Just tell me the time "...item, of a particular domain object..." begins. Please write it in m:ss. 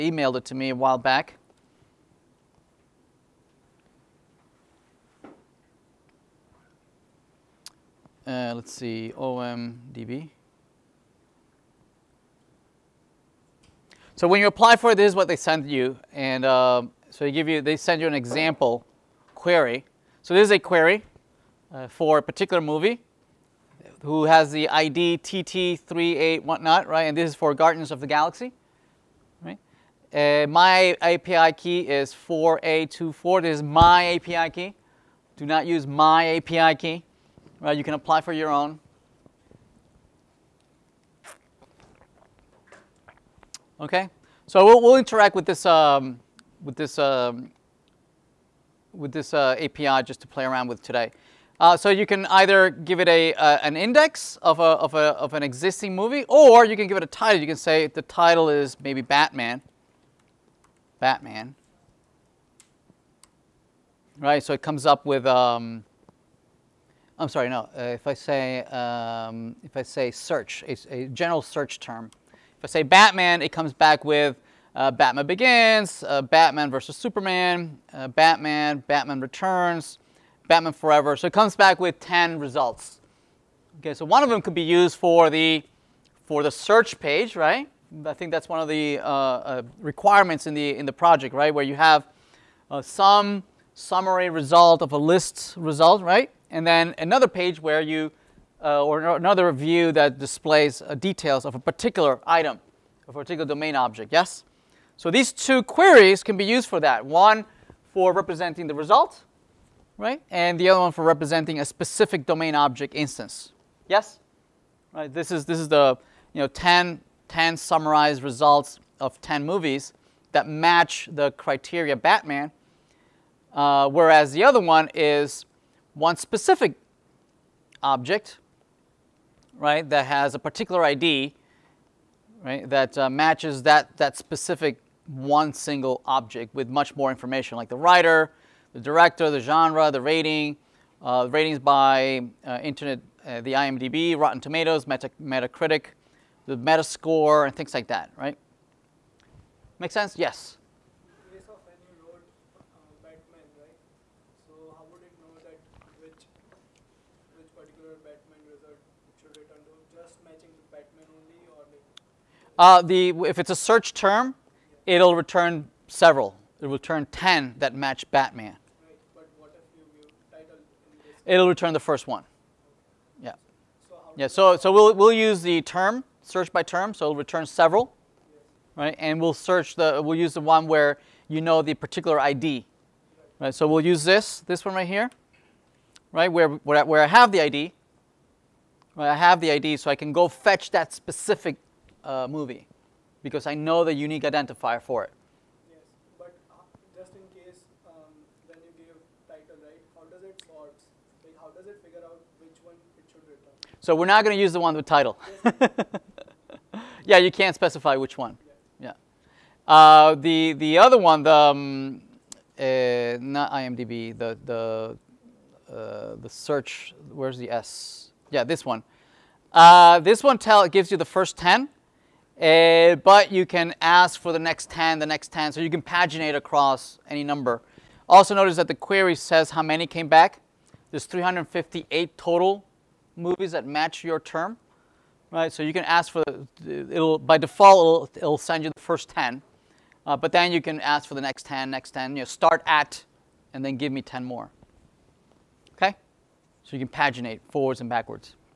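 1:42.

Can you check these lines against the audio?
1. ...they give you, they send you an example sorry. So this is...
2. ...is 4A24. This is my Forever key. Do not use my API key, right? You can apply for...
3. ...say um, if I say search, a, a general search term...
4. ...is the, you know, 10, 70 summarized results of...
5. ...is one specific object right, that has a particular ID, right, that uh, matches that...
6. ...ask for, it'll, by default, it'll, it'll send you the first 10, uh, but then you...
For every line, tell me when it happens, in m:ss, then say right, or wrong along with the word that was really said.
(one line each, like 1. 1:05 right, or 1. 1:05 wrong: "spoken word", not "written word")
1. 0:17 wrong: "query", not "sorry"
2. 0:31 wrong: "API", not "Forever"
3. 1:08 right
4. 1:55 wrong: "10", not "70"
5. 2:04 right
6. 3:55 right.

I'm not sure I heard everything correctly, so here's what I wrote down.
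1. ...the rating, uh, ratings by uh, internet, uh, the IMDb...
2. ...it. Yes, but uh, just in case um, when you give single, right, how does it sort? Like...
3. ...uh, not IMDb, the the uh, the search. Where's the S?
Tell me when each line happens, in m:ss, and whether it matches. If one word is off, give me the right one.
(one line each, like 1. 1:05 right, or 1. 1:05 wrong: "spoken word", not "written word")
1. 2:19 right
2. 3:15 wrong: "title", not "single"
3. 3:32 right.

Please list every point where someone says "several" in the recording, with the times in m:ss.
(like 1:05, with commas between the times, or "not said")
2:45, 2:57.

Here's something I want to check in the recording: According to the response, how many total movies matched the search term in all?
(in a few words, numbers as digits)
358.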